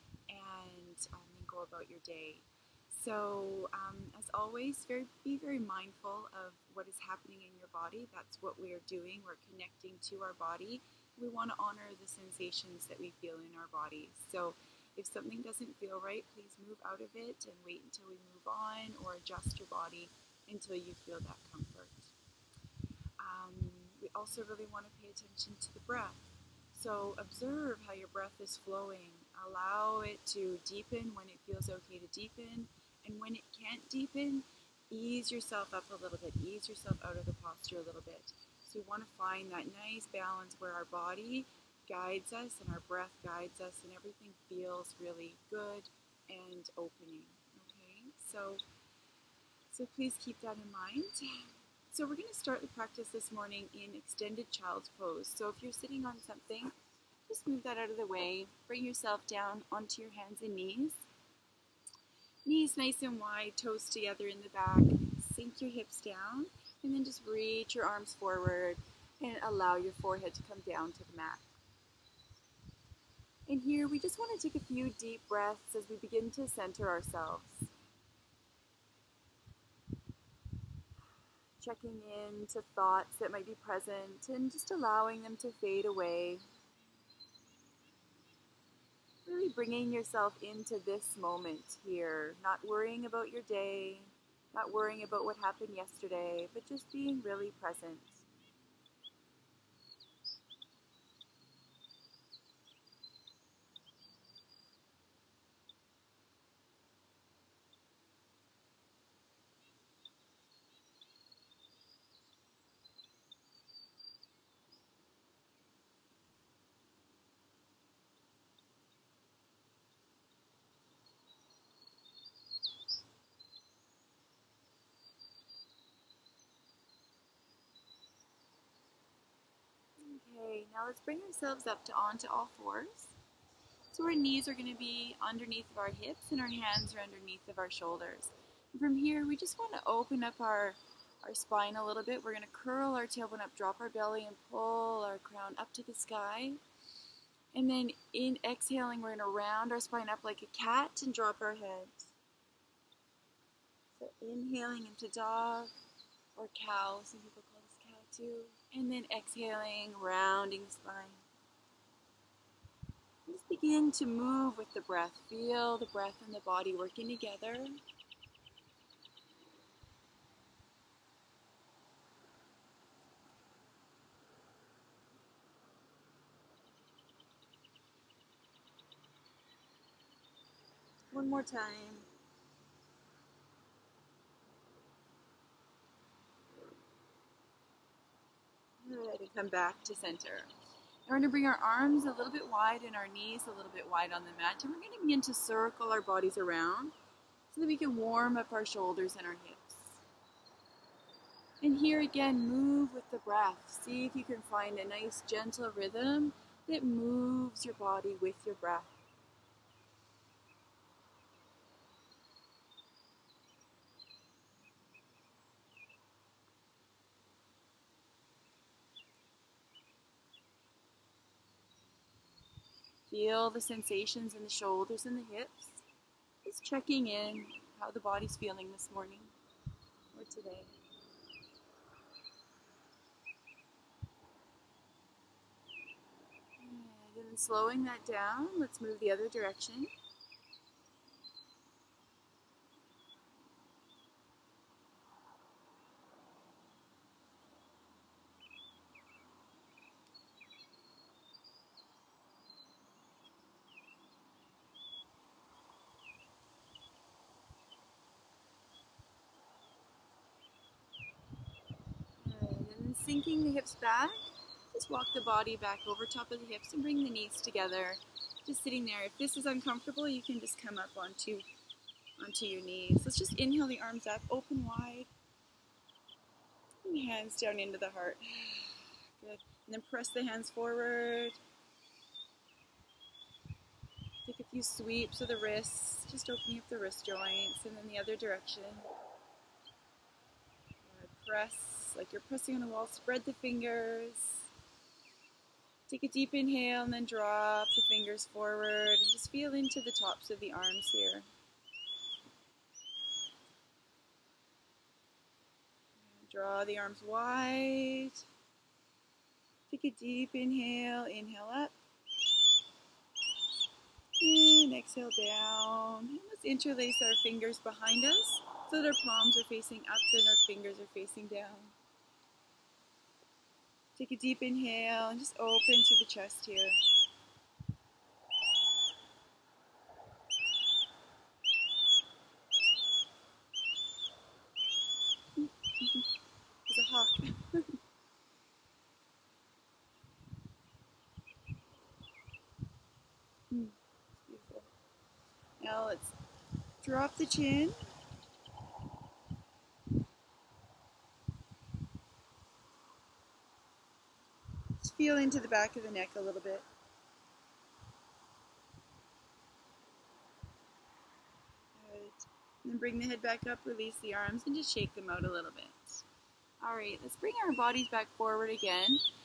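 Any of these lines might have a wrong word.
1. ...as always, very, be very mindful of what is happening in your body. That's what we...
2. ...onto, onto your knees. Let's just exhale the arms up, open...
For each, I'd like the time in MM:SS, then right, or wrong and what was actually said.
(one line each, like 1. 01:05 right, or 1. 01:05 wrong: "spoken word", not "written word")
1. 00:04 right
2. 04:30 wrong: "inhale", not "exhale".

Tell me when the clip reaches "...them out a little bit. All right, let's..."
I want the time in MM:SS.
06:04.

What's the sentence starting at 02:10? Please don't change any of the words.
Okay, now let's bring ourselves up to onto all fours.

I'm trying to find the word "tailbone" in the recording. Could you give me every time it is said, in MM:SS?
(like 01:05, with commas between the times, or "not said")
02:23.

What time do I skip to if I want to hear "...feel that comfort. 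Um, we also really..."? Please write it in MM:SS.
00:21.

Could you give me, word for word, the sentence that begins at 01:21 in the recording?
Checking in to thoughts that might be present and just allowing them to fade away.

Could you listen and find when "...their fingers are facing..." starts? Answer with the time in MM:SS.
05:20.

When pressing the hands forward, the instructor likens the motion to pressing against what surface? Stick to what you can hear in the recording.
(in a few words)
The wall.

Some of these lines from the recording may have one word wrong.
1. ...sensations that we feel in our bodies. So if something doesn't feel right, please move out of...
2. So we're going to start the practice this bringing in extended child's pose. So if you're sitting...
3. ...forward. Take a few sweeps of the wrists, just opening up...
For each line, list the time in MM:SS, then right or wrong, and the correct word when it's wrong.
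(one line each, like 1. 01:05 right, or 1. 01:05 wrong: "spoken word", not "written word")
1. 00:12 right
2. 00:51 wrong: "morning", not "bringing"
3. 04:40 right.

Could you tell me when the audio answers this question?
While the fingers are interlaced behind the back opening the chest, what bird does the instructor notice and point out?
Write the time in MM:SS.
05:36.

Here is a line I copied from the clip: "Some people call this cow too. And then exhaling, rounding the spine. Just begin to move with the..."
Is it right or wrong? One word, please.
right.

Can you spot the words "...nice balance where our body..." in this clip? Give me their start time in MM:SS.
00:39.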